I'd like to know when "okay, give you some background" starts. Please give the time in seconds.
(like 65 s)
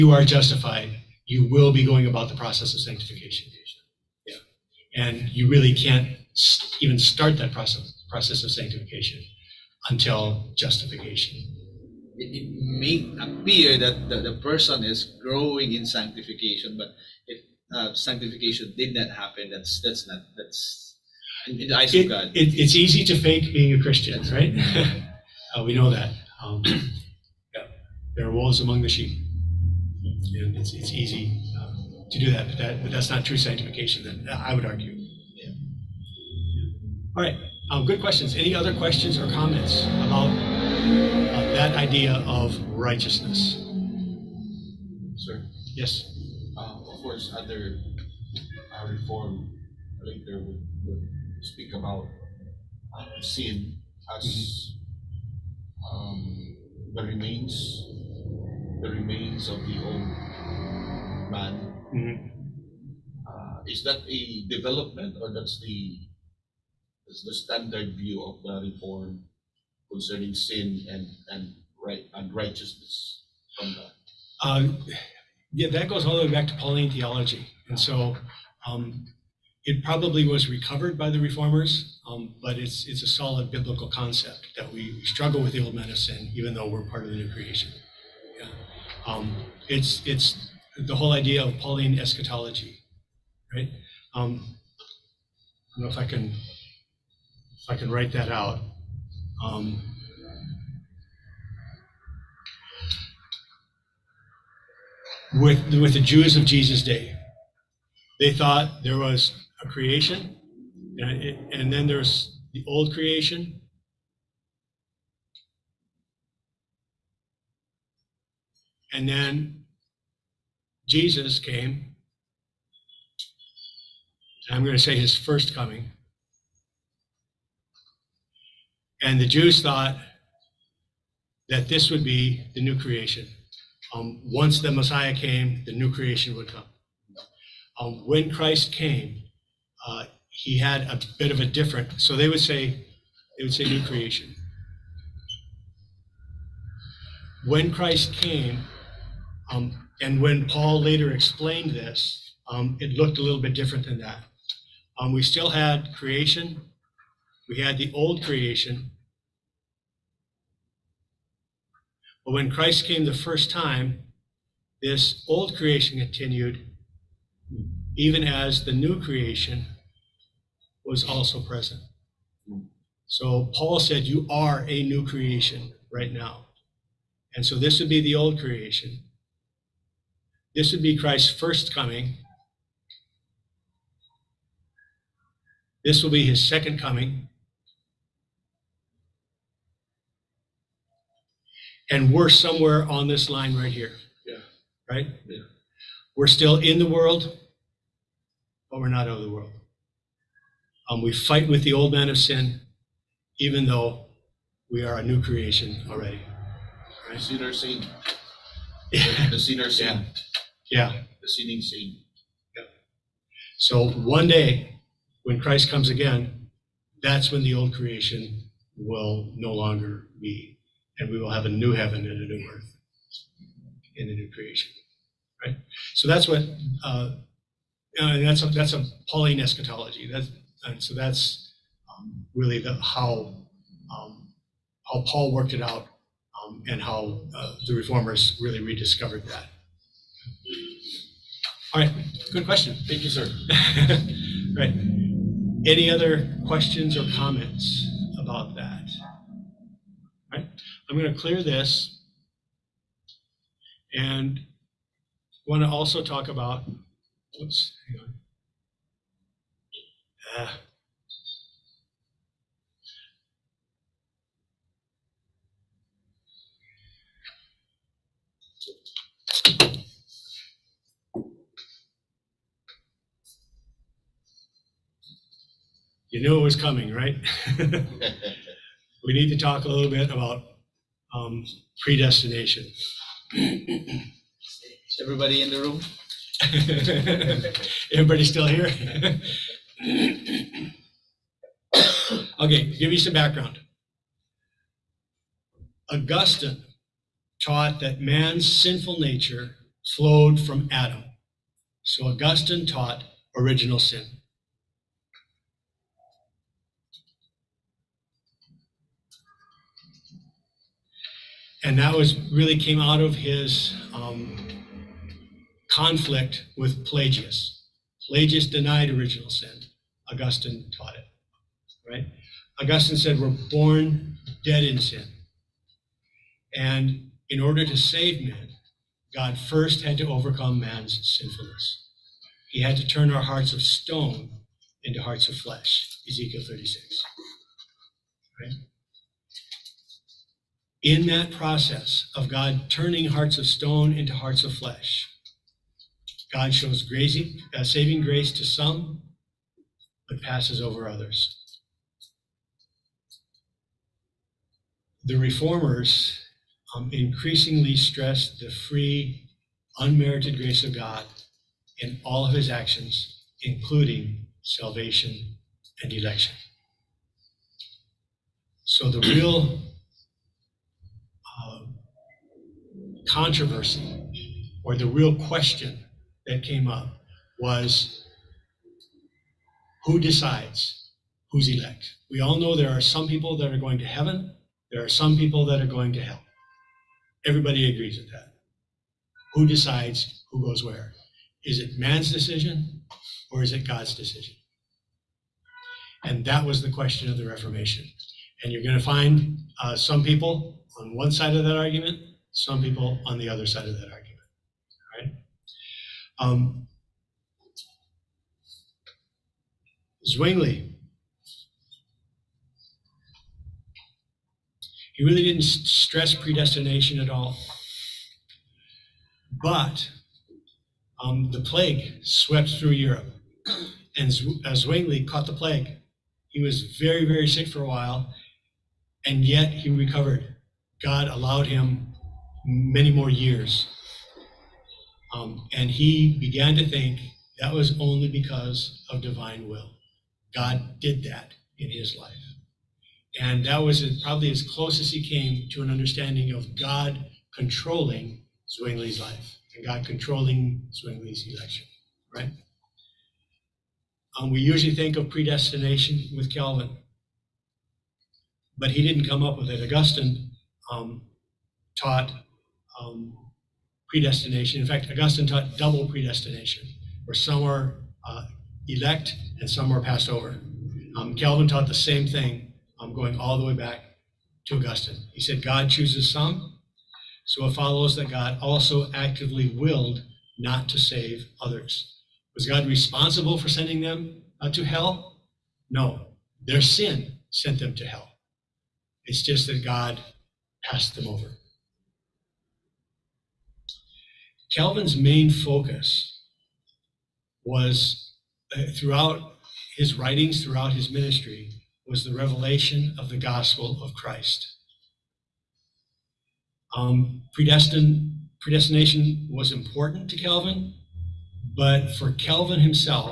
292 s.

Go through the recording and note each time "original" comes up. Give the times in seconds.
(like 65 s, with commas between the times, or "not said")
303 s, 318 s.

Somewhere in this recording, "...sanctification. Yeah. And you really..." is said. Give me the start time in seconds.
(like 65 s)
2 s.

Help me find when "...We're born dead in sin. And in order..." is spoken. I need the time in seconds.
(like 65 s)
323 s.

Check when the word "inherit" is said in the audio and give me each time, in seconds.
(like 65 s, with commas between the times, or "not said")
not said.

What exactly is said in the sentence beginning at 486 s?
Their sin sent them to hell.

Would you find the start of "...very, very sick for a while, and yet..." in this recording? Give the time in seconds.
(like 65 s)
426 s.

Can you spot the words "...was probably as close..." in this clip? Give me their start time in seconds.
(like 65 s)
443 s.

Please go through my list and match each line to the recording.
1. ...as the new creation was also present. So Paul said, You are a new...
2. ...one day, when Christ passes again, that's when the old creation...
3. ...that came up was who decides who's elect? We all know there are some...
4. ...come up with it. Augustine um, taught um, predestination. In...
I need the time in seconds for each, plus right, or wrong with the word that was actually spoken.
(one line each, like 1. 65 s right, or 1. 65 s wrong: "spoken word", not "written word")
1. 168 s right
2. 213 s wrong: "comes", not "passes"
3. 376 s right
4. 459 s right.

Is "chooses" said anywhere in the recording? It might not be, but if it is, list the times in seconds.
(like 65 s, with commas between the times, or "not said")
475 s.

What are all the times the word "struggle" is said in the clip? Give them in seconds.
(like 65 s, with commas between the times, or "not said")
85 s.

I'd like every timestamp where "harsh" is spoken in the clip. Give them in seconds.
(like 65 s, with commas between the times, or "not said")
not said.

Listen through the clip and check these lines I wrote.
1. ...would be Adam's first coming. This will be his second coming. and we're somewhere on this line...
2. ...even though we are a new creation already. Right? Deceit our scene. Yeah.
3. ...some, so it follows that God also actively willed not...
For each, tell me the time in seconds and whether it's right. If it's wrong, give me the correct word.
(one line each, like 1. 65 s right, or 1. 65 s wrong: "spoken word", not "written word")
1. 180 s wrong: "Christ", not "Adam"
2. 203 s right
3. 476 s right.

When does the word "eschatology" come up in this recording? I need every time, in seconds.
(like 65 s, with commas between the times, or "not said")
91 s, 229 s.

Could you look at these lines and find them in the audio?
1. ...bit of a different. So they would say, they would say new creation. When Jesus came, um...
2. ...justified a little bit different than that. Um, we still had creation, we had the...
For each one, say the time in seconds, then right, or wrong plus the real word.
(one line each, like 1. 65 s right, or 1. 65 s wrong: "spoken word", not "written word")
1. 141 s wrong: "Christ", not "Jesus"
2. 152 s wrong: "looked", not "justified".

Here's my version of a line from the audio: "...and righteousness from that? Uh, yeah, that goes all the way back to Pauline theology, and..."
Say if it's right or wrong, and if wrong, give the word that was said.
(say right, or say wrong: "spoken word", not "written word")
right.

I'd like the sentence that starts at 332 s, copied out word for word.
He had to turn our hearts of stone into hearts of flesh, Ezekiel 36.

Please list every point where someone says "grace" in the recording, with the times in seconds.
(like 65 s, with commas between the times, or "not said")
348 s, 360 s.